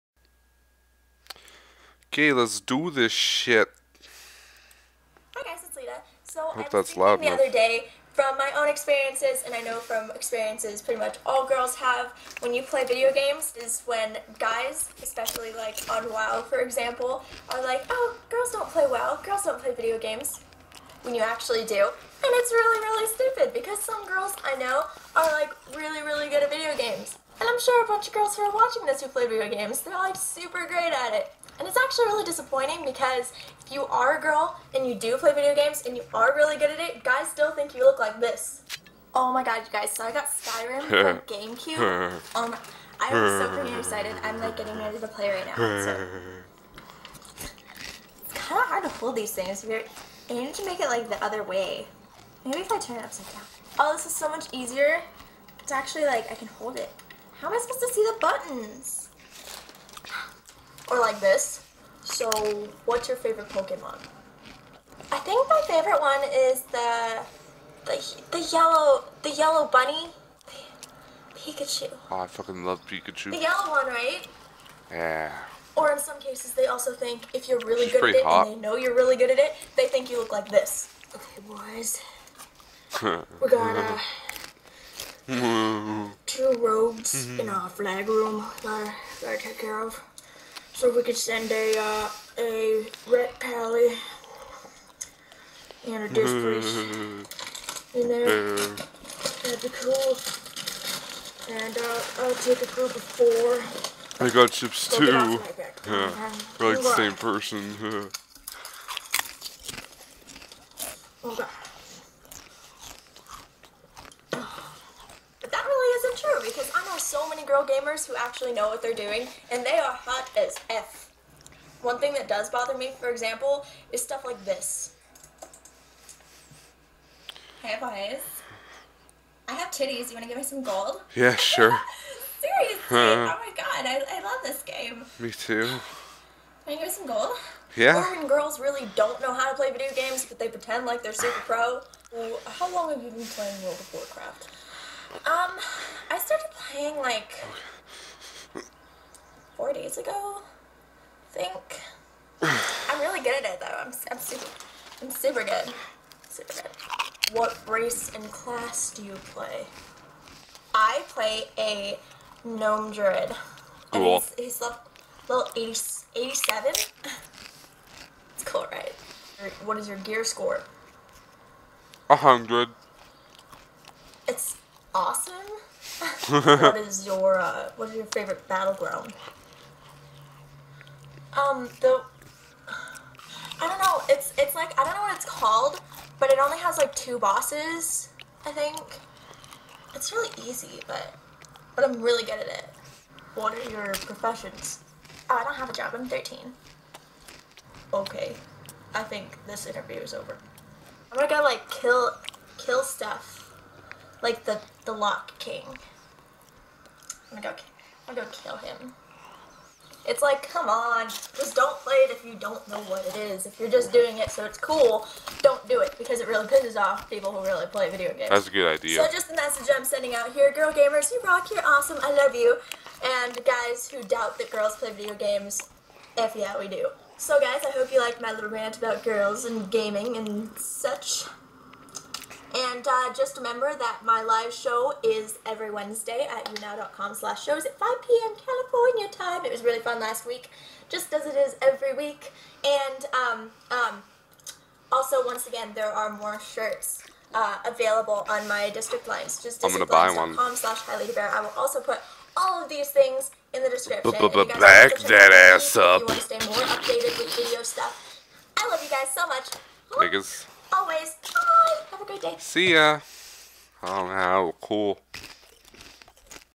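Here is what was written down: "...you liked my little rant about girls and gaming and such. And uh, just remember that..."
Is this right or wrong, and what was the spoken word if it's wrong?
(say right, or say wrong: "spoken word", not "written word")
right.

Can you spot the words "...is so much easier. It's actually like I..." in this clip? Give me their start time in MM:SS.
00:54.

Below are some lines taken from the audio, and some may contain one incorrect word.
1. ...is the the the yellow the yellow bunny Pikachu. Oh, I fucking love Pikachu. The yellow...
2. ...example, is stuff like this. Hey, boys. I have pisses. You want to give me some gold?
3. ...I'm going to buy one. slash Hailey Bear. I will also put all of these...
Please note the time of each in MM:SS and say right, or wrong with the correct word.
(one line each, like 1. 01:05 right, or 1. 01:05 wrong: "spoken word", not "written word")
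1. 01:06 right
2. 02:03 wrong: "titties", not "pisses"
3. 04:09 right.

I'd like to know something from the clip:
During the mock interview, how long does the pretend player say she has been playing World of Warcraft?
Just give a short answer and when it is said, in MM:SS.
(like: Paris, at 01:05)
4 days, at 02:29.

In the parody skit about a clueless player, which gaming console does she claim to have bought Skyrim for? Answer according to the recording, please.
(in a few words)
GameCube.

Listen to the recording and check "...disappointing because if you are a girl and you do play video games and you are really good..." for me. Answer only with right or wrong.
right.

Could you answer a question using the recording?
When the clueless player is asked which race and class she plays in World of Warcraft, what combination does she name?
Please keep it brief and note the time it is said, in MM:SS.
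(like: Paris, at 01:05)
Gnome druid, at 02:42.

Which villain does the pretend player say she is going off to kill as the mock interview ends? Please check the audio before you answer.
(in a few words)
The Lich King.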